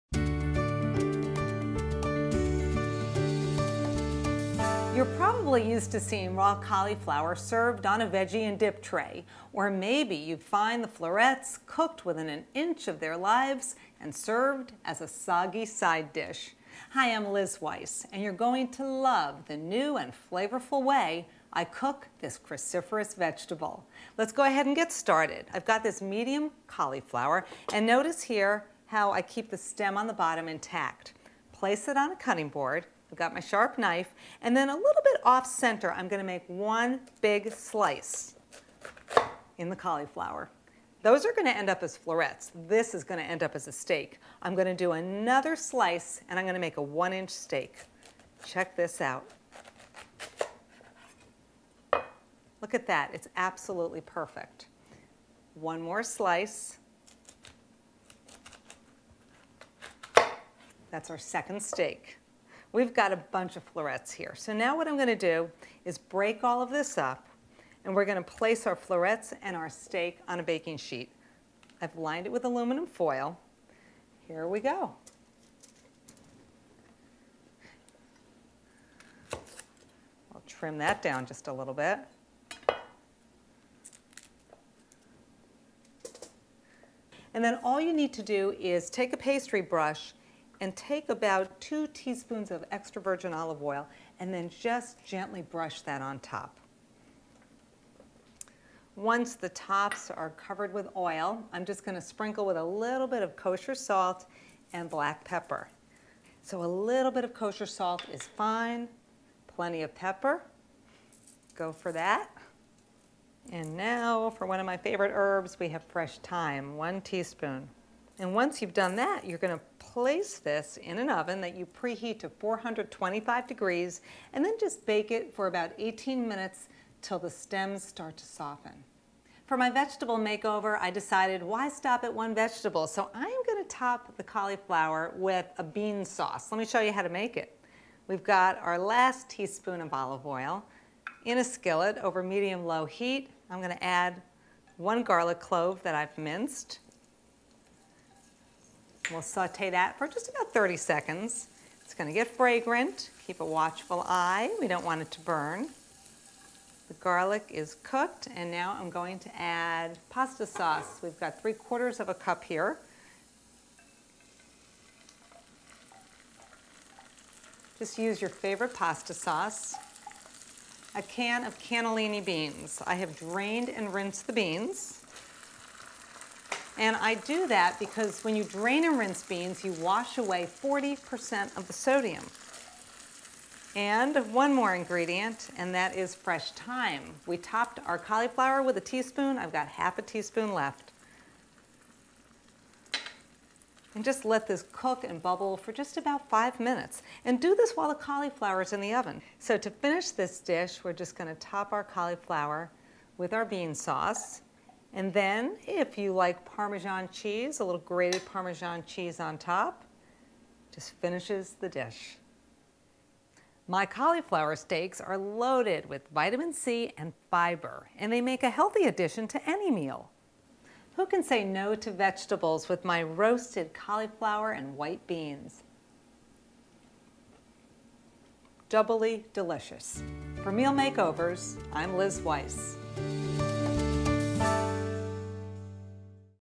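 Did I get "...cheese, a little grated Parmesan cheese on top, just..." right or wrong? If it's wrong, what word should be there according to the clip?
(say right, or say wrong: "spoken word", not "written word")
right.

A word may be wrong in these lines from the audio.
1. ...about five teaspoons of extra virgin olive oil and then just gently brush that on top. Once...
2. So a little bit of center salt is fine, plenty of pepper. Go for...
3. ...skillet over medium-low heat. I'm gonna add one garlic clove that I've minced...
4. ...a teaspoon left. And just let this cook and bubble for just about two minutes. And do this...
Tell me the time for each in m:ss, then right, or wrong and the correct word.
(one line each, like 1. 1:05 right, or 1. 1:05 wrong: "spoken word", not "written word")
1. 1:31 wrong: "two", not "five"
2. 1:46 wrong: "kosher", not "center"
3. 2:21 right
4. 3:09 wrong: "five", not "two".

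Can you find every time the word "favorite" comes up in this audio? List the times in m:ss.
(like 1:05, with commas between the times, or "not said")
1:54, 2:48.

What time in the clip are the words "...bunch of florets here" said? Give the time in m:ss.
1:03.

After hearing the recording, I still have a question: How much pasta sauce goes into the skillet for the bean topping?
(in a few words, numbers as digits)
3/4 cup.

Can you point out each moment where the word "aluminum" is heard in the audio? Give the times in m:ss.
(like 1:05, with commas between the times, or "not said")
1:12.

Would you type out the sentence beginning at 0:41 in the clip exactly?
Those are gonna end up as florets.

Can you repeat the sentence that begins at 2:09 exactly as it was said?
For my vegetable makeover, I decided why stop at one vegetable?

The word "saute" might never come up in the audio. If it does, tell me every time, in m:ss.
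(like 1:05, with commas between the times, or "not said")
2:29.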